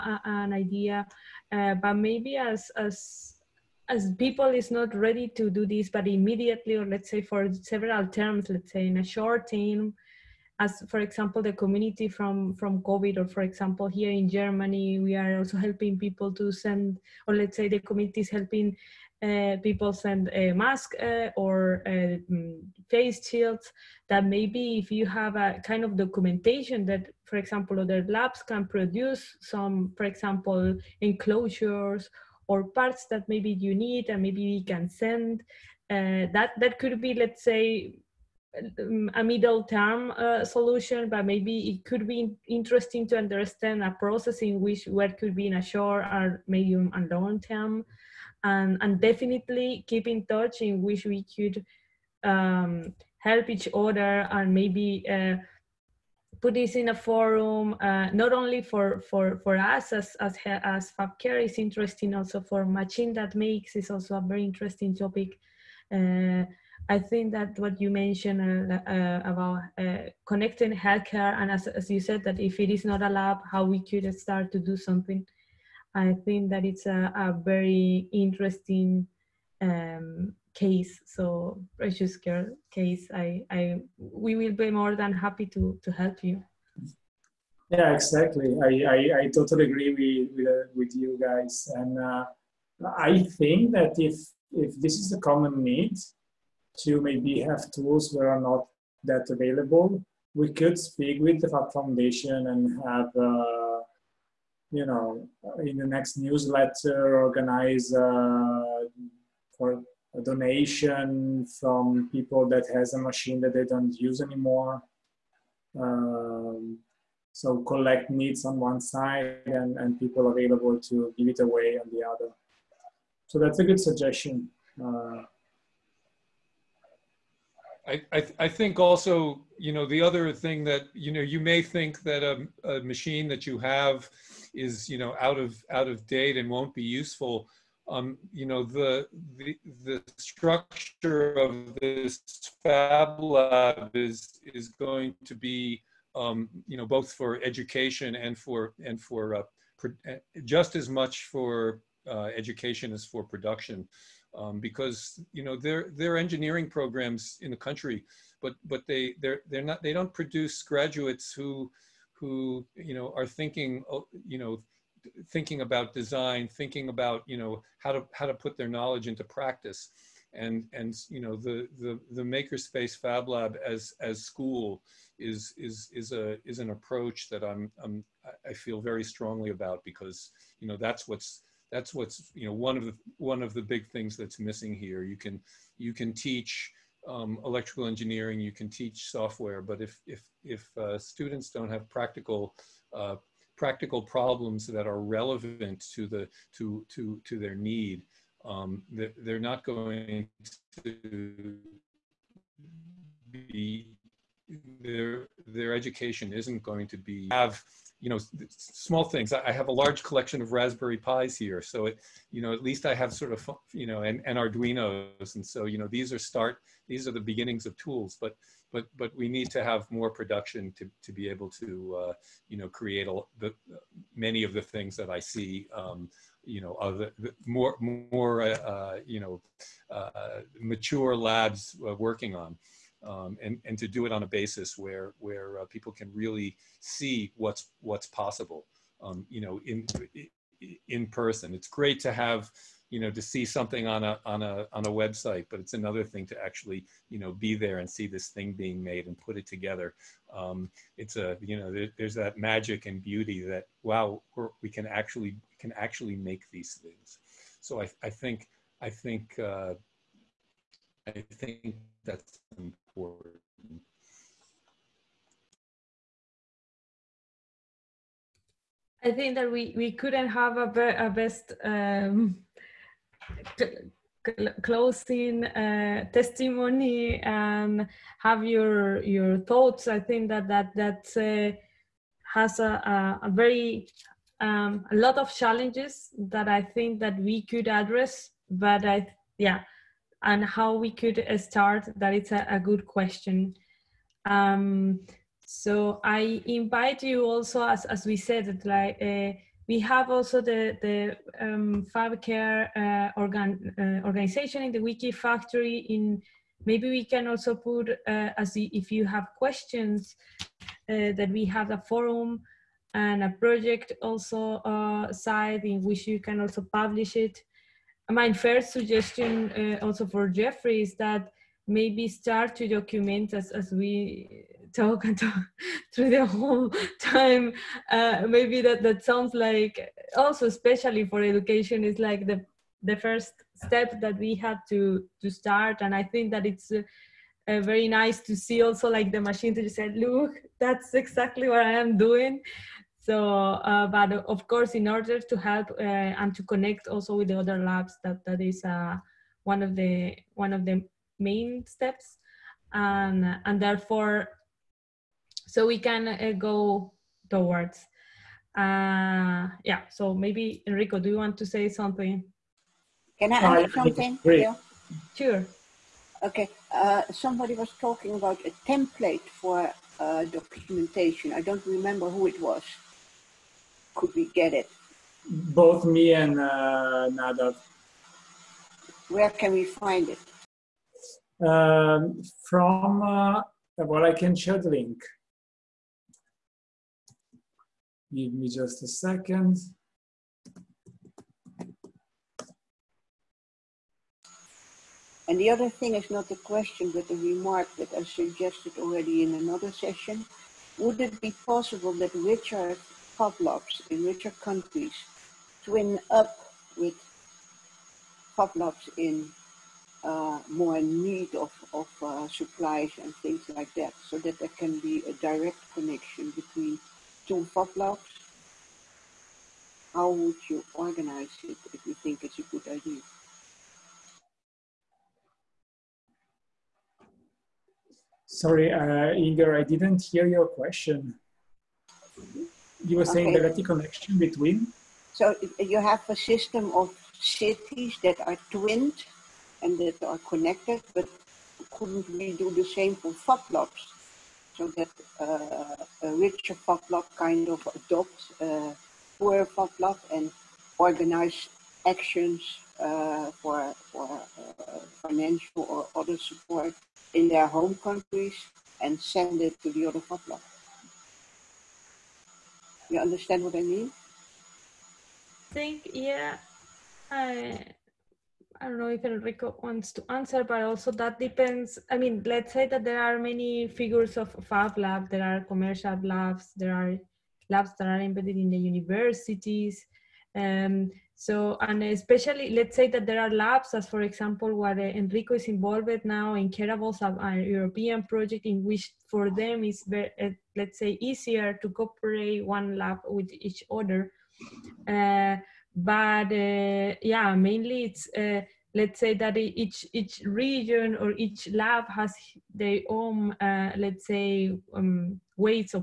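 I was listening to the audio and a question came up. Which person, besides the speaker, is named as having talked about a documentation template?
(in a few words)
Nadav.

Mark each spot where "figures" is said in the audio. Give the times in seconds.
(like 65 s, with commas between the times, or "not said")
473 s.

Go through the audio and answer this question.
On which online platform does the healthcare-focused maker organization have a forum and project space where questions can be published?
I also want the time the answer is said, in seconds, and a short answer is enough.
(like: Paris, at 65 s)
Wikifactory, at 304 s.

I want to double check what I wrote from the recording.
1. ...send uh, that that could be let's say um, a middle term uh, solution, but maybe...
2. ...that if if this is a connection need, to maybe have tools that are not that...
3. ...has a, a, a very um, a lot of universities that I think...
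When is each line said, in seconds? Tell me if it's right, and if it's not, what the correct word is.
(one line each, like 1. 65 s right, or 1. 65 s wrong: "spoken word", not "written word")
1. 34 s right
2. 93 s wrong: "common", not "connection"
3. 282 s wrong: "challenges", not "universities".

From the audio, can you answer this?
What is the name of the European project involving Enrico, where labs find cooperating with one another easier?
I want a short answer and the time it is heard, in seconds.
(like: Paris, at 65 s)
Careables, at 486 s.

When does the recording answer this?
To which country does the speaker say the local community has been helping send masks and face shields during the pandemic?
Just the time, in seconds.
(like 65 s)
14 s.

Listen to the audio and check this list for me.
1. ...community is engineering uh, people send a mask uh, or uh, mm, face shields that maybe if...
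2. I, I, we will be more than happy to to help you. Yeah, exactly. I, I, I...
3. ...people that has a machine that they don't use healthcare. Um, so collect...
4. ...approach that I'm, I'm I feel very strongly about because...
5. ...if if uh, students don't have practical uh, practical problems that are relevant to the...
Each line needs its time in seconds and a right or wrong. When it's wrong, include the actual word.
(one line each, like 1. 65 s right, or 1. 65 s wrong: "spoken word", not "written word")
1. 17 s wrong: "helping", not "engineering"
2. 83 s right
3. 112 s wrong: "anymore", not "healthcare"
4. 176 s right
5. 190 s right.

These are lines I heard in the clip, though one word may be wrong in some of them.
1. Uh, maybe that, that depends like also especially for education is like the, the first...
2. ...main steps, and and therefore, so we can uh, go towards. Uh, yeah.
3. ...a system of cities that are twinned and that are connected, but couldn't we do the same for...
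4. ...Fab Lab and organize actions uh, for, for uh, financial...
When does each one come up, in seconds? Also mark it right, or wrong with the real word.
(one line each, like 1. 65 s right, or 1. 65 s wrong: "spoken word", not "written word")
1. 327 s wrong: "sounds", not "depends"
2. 351 s right
3. 436 s right
4. 449 s right.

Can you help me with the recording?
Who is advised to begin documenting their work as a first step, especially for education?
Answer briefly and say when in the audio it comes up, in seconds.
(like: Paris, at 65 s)
Jeffrey, at 320 s.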